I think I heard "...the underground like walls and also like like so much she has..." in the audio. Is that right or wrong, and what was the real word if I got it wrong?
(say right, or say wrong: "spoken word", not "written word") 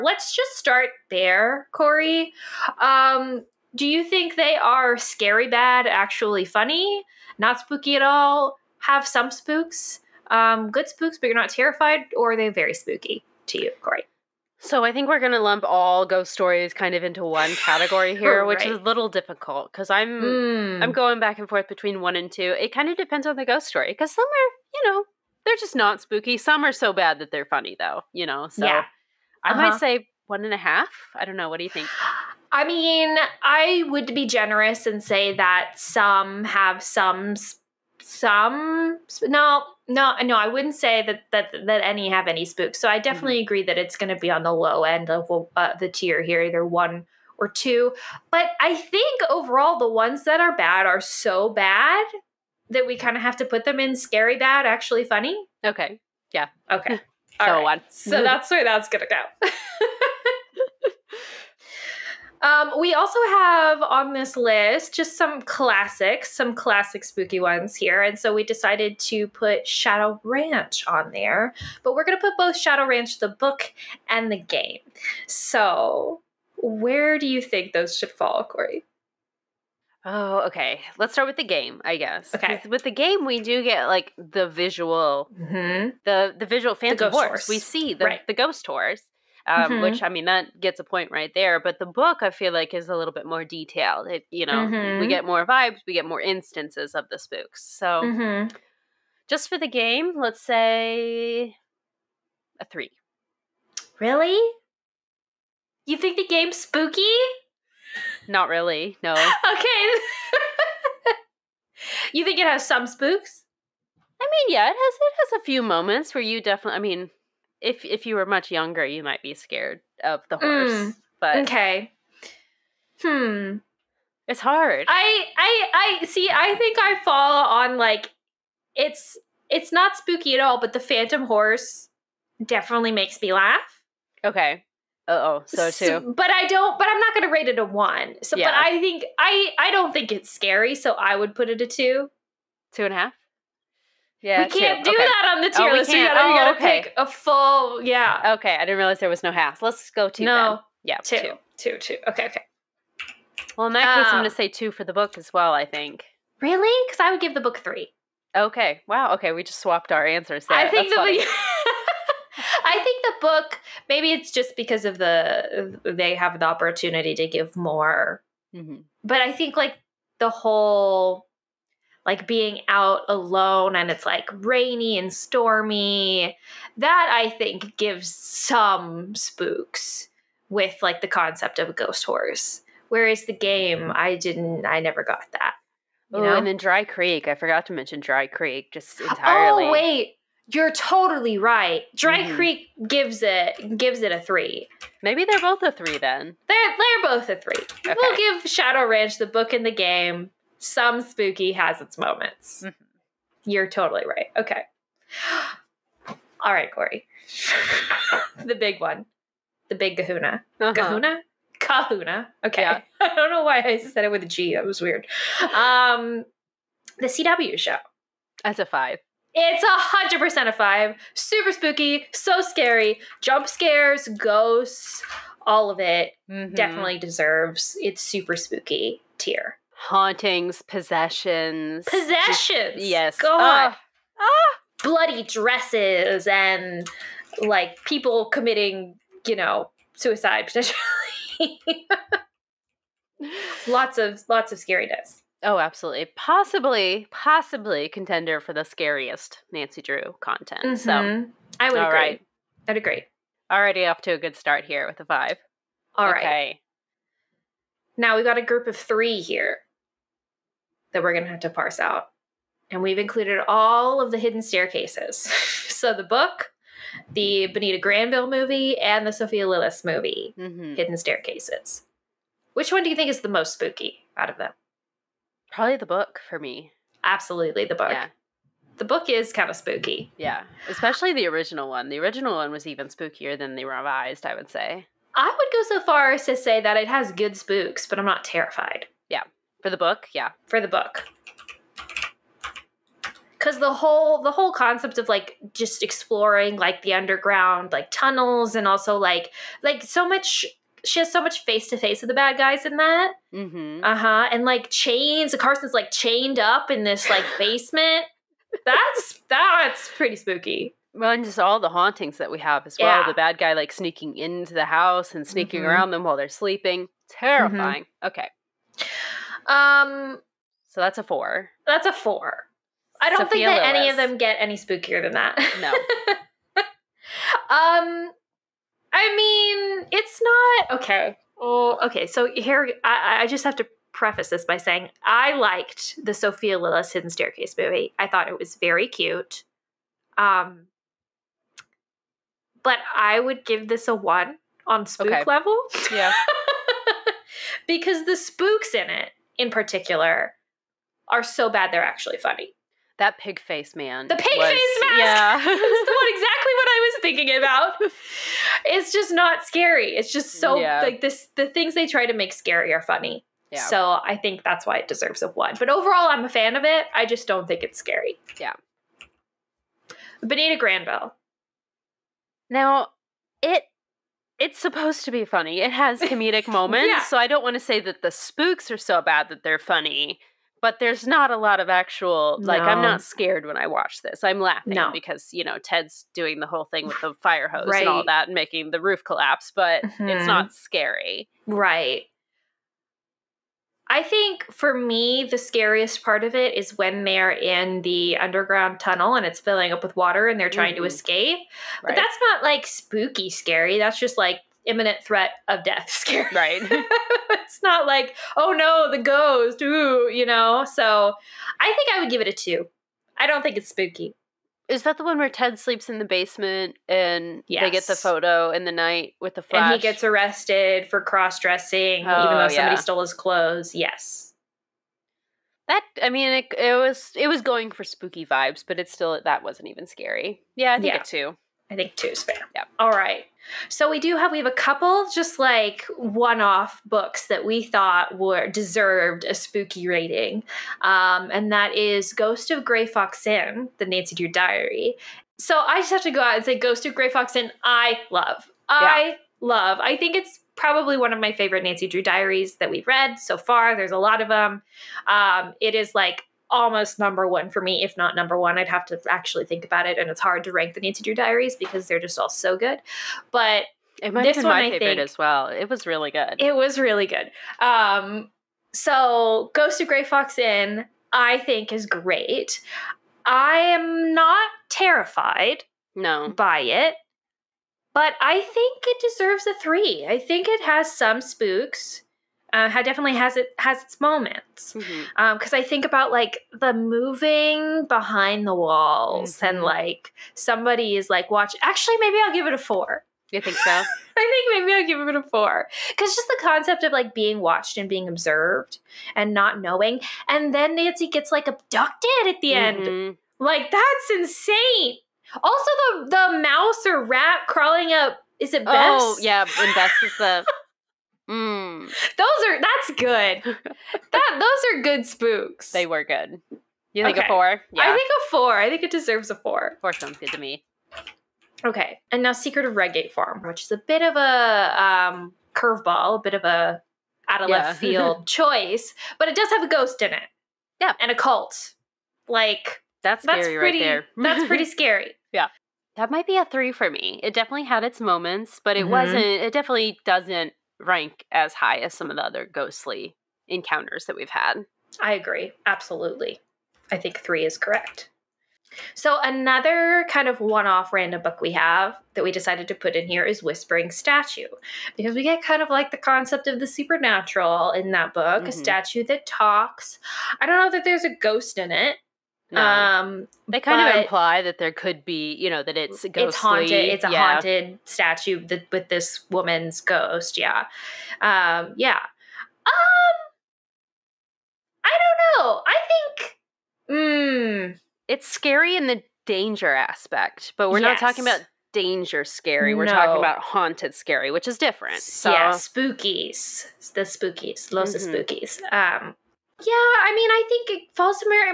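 wrong: "tunnels", not "walls".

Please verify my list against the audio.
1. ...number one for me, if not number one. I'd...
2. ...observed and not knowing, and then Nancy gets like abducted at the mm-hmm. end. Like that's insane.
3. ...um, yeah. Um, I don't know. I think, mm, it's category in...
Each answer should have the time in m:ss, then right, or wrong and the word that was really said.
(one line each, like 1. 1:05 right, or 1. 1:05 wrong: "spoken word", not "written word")
1. 7:36 right
2. 8:18 right
3. 9:31 wrong: "scary", not "category".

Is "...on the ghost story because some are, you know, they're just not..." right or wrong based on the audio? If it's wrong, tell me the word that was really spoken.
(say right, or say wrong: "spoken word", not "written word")
right.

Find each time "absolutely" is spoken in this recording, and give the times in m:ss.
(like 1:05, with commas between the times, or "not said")
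4:05, 4:37, 9:05.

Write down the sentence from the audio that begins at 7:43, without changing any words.
But it might this be one, my I favorite think, as well.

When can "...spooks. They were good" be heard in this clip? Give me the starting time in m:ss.
8:35.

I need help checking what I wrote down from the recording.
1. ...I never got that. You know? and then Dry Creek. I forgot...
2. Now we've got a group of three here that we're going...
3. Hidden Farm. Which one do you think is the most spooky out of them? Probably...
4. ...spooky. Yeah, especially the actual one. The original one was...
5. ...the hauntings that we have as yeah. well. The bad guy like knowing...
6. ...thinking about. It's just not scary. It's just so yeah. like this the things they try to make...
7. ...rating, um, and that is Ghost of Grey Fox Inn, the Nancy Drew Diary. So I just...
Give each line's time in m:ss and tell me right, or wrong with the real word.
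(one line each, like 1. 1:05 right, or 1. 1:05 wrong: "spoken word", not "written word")
1. 3:04 right
2. 4:17 right
3. 4:30 wrong: "Staircases", not "Farm"
4. 4:39 wrong: "original", not "actual"
5. 5:11 wrong: "sneaking", not "knowing"
6. 5:57 right
7. 7:19 right.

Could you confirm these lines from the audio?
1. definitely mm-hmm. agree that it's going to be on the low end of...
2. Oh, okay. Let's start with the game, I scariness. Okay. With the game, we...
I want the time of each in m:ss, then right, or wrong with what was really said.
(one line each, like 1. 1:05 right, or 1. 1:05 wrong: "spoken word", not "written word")
1. 0:43 right
2. 1:20 wrong: "guess", not "scariness".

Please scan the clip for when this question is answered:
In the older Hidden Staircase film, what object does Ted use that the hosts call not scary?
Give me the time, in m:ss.
6:27.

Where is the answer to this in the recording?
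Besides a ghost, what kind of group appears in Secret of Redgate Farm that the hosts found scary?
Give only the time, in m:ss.
8:51.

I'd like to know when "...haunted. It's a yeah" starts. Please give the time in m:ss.
9:26.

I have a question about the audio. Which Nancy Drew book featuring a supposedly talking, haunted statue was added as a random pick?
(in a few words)
Whispering Statue.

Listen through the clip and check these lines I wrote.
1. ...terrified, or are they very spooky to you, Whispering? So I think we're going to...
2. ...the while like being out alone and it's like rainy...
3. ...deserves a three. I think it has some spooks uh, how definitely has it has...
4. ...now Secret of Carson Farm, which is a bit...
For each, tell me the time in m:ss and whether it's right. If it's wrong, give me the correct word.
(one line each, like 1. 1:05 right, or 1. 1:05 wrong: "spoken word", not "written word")
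1. 0:11 wrong: "Corey", not "Whispering"
2. 2:50 wrong: "whole", not "while"
3. 7:59 right
4. 8:42 wrong: "Redgate", not "Carson".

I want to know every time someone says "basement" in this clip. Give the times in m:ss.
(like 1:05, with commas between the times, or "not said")
5:07, 6:56.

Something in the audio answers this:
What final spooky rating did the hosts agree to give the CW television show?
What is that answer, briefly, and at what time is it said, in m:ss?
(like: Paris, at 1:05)
5, at 3:38.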